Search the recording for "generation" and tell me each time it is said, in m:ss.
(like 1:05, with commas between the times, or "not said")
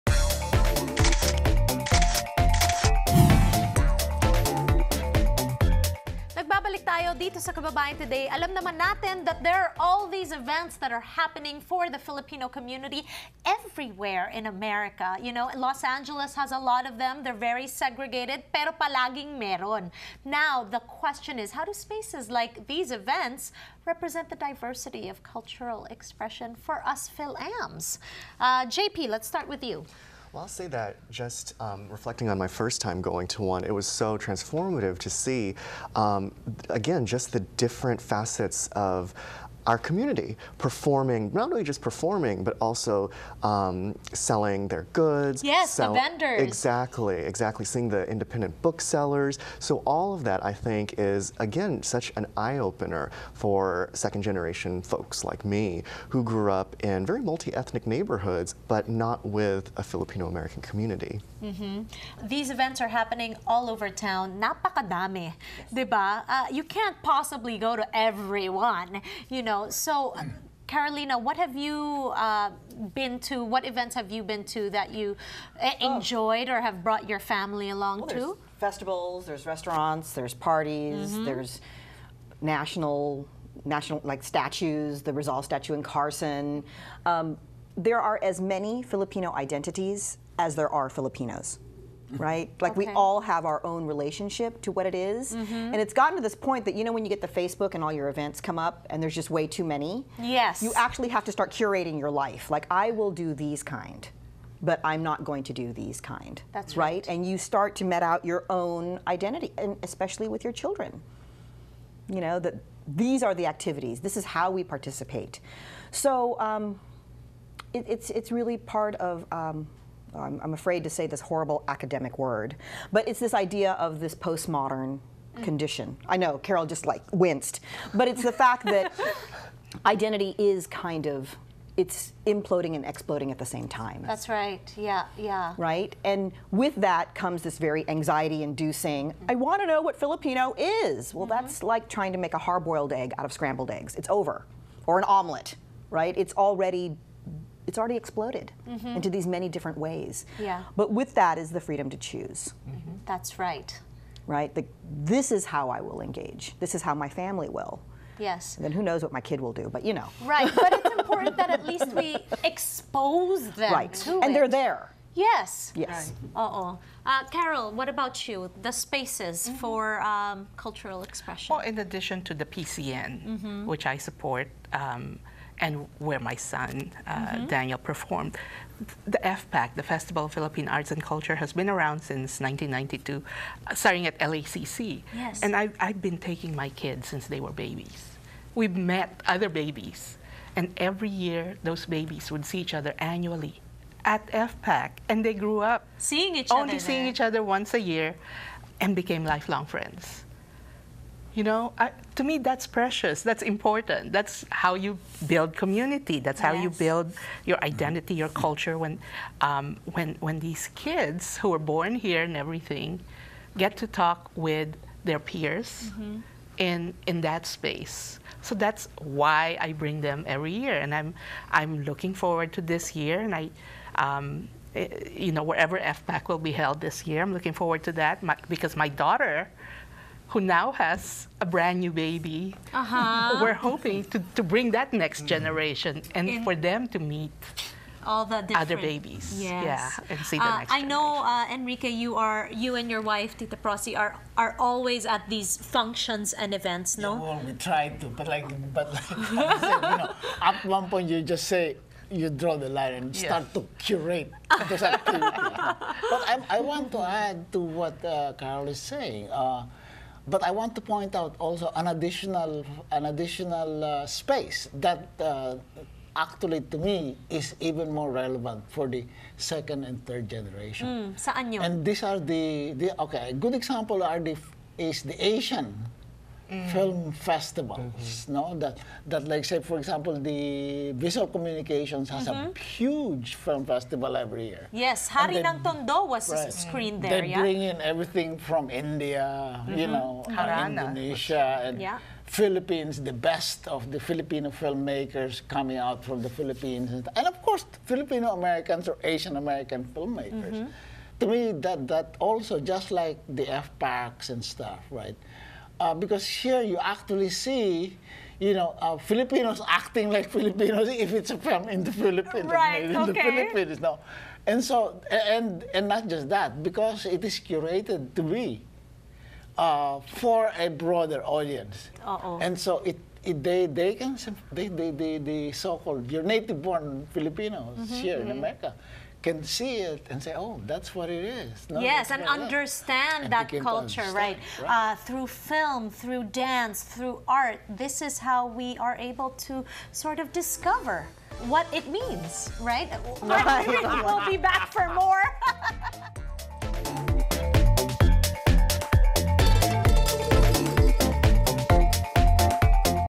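0:53, 3:55, 4:30.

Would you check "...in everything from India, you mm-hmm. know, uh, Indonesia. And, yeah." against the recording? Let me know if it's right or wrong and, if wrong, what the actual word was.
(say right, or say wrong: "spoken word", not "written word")
right.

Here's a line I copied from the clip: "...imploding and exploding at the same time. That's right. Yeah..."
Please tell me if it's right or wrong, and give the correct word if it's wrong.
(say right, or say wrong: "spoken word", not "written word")
right.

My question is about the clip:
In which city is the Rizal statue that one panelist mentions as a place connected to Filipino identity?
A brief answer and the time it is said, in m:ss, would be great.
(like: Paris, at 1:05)
Carson, at 1:25.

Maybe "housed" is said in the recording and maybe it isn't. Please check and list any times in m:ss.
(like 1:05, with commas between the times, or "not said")
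not said.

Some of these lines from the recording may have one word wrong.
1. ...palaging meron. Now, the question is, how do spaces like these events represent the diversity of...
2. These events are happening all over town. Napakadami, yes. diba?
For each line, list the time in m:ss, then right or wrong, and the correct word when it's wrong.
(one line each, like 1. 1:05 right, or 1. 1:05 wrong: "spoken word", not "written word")
1. 0:18 right
2. 1:02 right.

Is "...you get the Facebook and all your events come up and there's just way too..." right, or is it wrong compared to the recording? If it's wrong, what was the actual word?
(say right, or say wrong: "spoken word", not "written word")
right.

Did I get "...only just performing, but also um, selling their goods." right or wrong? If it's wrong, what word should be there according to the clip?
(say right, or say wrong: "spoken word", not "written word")
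right.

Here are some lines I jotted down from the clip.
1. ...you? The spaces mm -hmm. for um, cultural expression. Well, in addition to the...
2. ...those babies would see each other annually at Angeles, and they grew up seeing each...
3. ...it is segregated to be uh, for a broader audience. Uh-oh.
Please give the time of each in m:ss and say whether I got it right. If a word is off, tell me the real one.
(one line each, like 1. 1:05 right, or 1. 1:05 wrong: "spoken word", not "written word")
1. 2:48 right
2. 3:11 wrong: "FPAC", not "Angeles"
3. 5:17 wrong: "curated", not "segregated".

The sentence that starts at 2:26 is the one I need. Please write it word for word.
It's already it's already exploded mm -hmm.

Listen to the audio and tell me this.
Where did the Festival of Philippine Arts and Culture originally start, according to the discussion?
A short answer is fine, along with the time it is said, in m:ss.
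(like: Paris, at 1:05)
LACC, at 3:04.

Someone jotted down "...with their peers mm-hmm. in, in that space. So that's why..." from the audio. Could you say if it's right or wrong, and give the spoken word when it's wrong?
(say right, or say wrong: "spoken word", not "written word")
right.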